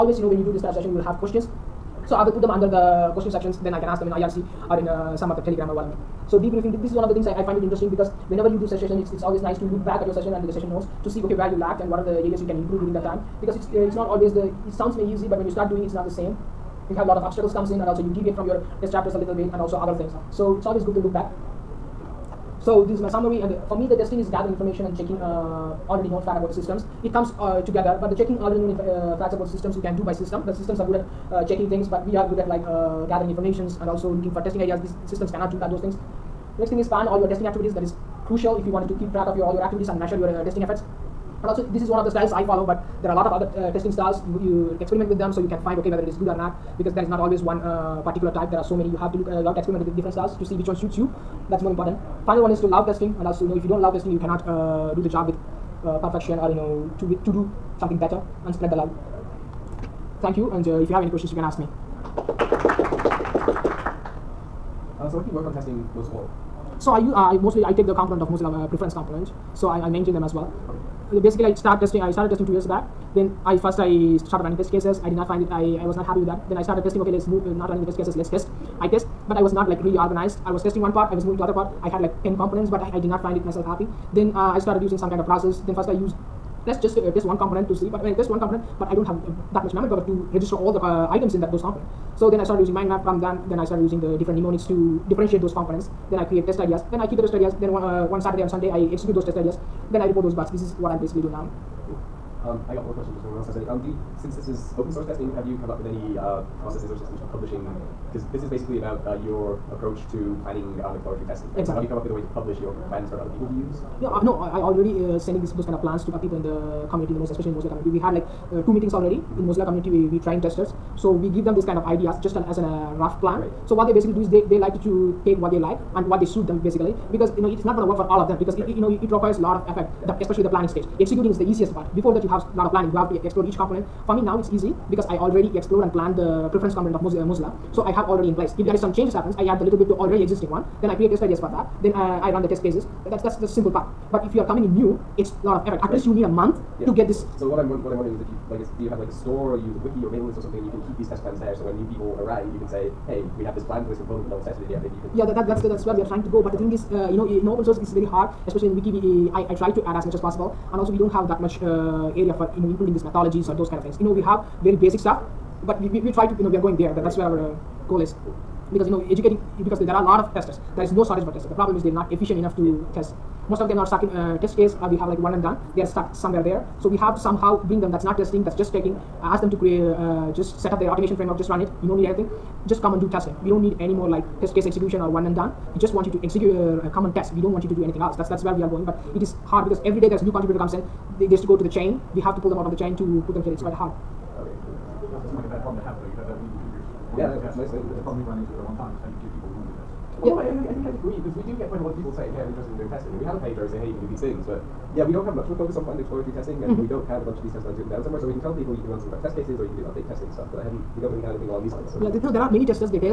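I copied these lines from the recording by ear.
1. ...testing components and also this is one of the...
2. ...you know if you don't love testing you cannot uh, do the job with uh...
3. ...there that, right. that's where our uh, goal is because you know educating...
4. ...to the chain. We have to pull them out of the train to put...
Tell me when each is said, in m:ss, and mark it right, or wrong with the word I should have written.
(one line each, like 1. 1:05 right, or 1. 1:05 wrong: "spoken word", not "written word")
1. 0:40 wrong: "efforts", not "components"
2. 0:53 right
3. 2:46 right
4. 3:11 wrong: "chain", not "train".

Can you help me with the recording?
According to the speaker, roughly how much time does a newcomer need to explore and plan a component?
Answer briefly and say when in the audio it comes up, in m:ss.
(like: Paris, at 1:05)
A month, at 2:26.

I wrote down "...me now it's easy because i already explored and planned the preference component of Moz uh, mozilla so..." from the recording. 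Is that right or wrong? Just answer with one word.
right.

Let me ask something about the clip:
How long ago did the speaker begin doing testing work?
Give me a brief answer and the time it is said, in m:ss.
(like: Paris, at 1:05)
Two years, at 1:12.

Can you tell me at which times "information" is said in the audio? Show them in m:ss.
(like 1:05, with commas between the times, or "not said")
0:24, 0:33.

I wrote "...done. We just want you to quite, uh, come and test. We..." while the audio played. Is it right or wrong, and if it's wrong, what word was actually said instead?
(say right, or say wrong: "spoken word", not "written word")
wrong: "execute", not "quite".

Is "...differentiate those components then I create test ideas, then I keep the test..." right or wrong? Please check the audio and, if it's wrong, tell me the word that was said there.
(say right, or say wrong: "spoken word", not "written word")
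right.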